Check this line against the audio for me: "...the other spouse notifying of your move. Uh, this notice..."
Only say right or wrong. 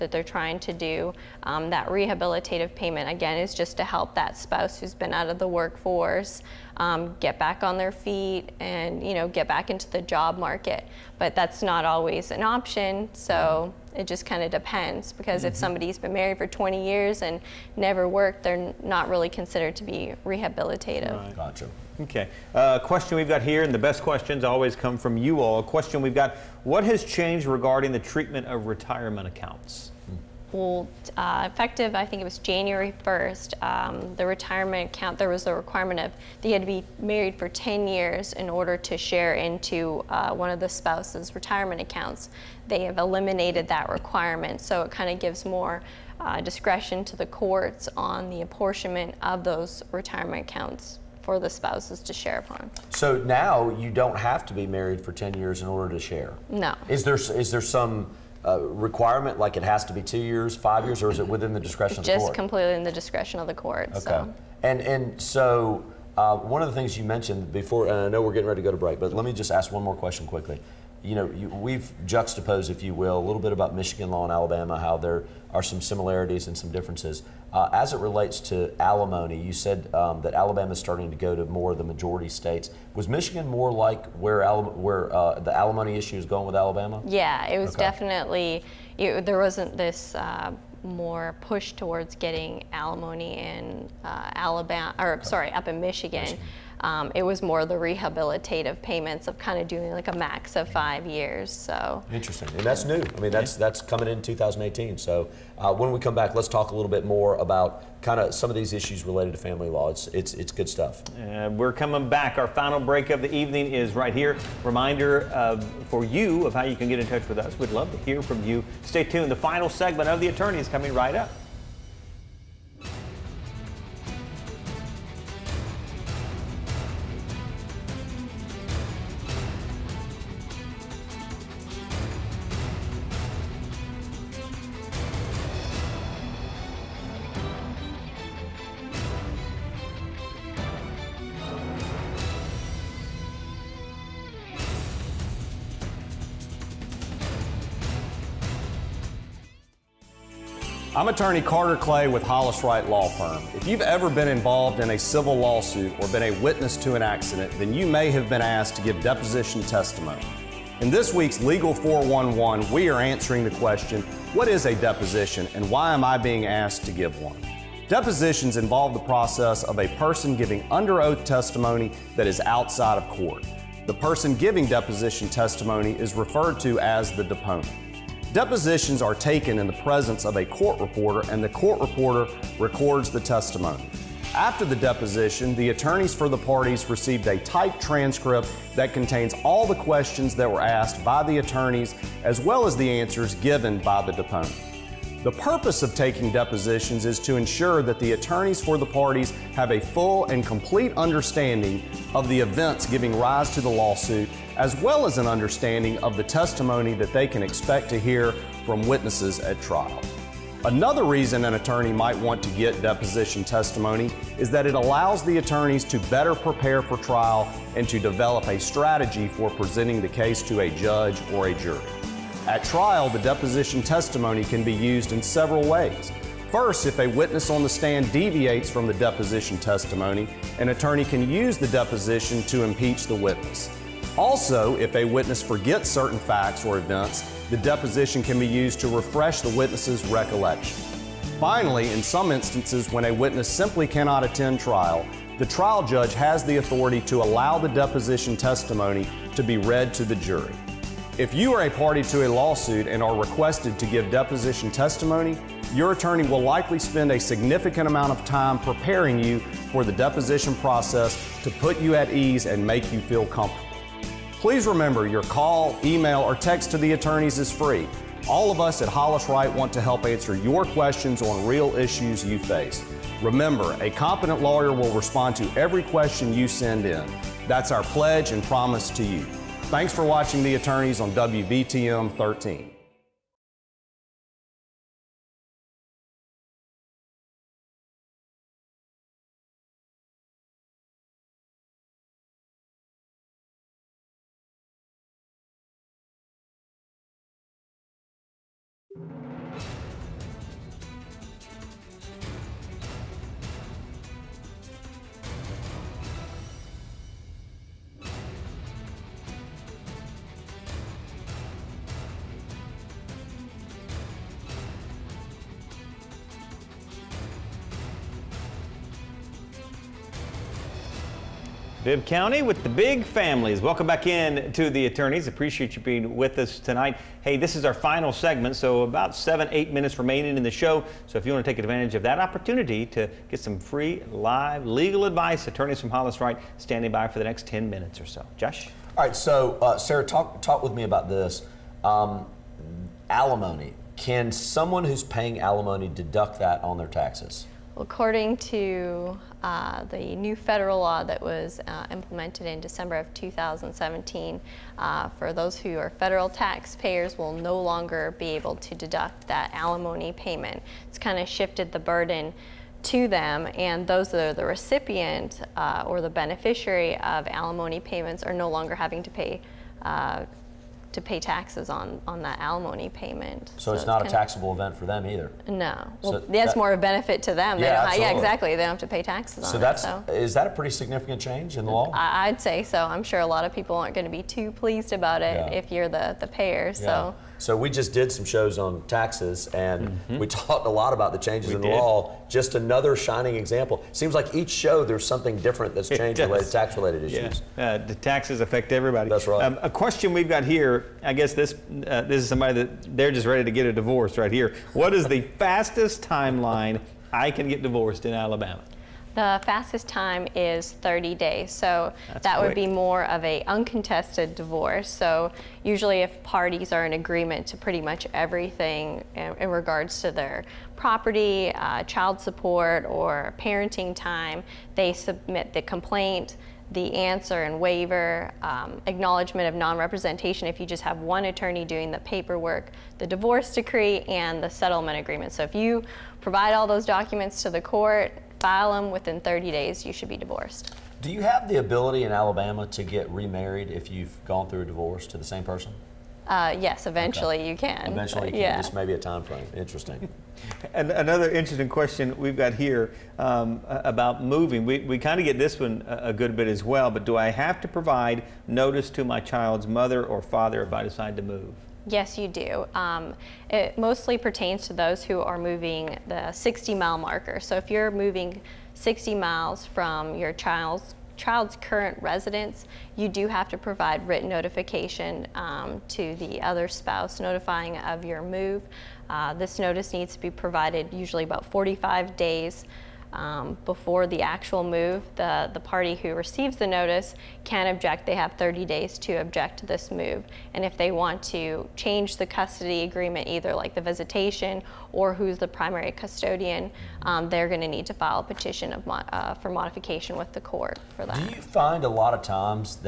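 right.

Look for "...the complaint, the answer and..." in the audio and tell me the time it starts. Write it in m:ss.
7:05.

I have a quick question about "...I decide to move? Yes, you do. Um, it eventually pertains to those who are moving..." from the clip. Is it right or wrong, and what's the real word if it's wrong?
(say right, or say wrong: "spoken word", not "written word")
wrong: "mostly", not "eventually".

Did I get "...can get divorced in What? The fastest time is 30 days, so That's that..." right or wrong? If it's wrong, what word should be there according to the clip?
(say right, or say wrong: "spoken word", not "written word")
wrong: "Alabama", not "What".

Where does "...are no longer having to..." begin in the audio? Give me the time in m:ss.
6:08.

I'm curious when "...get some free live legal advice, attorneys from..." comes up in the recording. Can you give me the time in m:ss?
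5:33.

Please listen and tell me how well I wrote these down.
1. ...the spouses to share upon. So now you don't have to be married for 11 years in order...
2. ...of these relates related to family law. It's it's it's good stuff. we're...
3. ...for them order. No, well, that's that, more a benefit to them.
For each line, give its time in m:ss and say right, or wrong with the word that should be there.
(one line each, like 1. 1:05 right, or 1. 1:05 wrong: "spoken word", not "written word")
1. 0:51 wrong: "10", not "11"
2. 1:48 wrong: "issues", not "relates"
3. 6:14 wrong: "either", not "order".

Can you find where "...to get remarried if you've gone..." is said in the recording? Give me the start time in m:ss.
7:22.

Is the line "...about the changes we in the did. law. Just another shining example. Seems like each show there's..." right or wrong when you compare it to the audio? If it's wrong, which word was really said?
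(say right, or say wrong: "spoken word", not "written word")
right.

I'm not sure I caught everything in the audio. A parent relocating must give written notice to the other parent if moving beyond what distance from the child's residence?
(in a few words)
60 miles.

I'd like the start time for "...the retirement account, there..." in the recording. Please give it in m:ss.
0:34.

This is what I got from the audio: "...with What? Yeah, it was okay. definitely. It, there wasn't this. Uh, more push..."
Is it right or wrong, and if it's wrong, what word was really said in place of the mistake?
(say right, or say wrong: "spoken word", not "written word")
wrong: "Alabama", not "What".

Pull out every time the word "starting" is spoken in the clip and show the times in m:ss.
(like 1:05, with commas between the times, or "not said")
1:20.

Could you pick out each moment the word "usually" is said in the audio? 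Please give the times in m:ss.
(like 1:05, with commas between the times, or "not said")
6:55, 8:00.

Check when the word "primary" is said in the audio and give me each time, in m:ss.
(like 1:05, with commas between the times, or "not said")
8:15.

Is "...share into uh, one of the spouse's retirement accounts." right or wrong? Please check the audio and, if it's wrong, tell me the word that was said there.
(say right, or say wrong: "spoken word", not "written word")
right.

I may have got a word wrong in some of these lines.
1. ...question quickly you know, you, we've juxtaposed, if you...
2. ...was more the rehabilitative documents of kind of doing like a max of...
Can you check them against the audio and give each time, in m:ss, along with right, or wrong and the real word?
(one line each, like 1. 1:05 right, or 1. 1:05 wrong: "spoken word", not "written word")
1. 1:09 right
2. 1:37 wrong: "payments", not "documents".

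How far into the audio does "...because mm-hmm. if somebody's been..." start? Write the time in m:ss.
0:15.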